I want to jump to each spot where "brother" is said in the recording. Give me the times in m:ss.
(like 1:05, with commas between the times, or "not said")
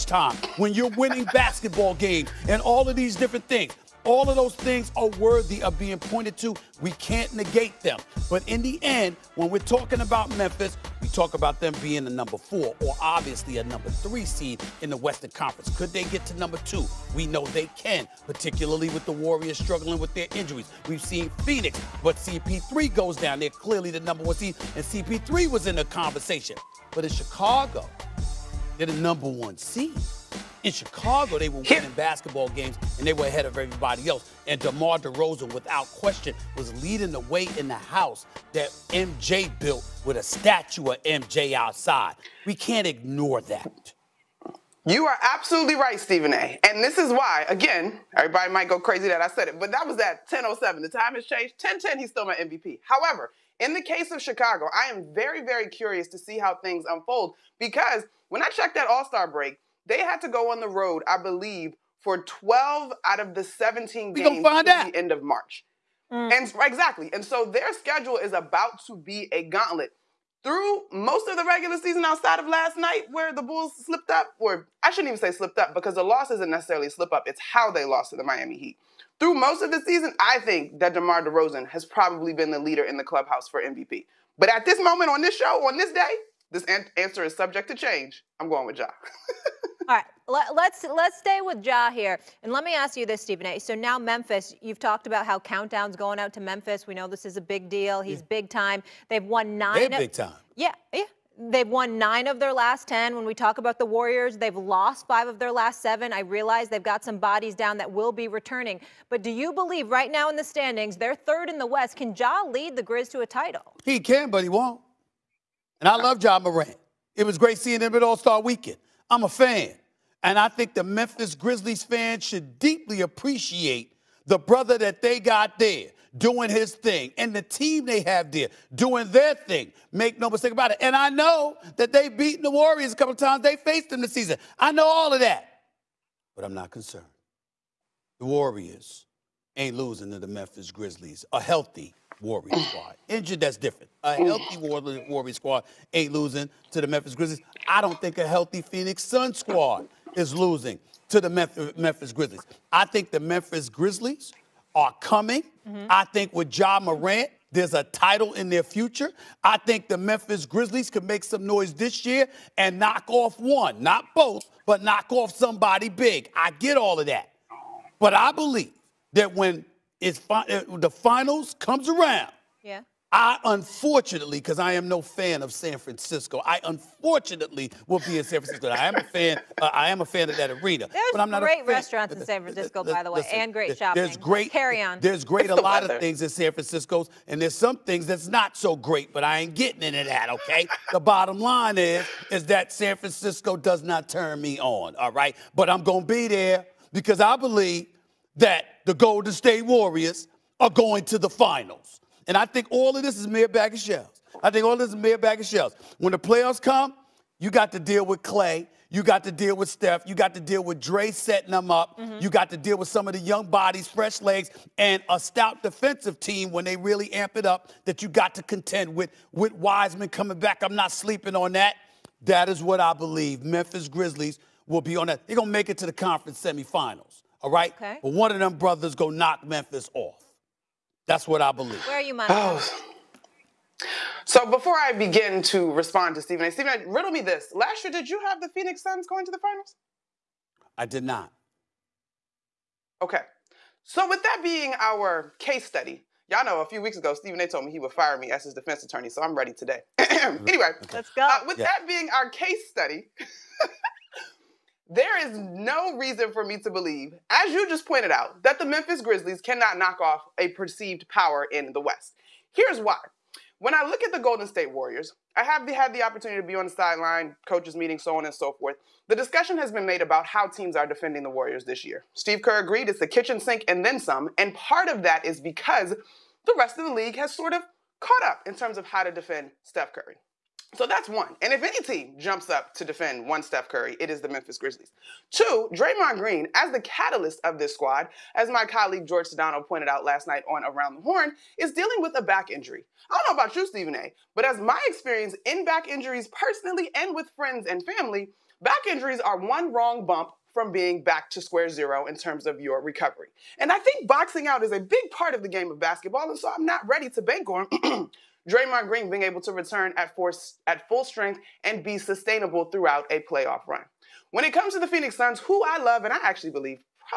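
2:04, 3:48.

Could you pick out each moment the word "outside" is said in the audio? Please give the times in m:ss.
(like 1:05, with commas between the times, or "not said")
0:41, 1:12.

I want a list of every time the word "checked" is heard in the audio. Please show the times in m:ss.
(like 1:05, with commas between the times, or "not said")
0:58.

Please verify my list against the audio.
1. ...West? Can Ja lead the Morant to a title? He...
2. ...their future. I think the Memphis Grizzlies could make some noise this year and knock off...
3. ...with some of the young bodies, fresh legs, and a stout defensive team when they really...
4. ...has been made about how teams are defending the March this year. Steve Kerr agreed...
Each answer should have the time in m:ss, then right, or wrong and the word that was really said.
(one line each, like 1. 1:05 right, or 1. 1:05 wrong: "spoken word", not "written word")
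1. 1:51 wrong: "Grizz", not "Morant"
2. 2:38 right
3. 3:32 right
4. 4:29 wrong: "Warriors", not "March".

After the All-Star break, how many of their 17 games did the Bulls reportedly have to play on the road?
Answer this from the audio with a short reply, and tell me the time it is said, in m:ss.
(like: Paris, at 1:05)
12, at 1:02.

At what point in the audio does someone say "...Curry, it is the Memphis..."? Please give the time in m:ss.
4:43.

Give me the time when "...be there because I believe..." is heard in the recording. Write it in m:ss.
3:16.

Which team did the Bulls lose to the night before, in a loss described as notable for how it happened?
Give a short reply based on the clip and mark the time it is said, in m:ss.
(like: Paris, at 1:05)
Miami Heat, at 1:18.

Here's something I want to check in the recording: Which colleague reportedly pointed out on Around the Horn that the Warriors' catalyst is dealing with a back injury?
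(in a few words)
George Sedano.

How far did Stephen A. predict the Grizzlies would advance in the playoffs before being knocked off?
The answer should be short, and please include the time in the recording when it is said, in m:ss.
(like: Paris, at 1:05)
conference semifinals, at 3:45.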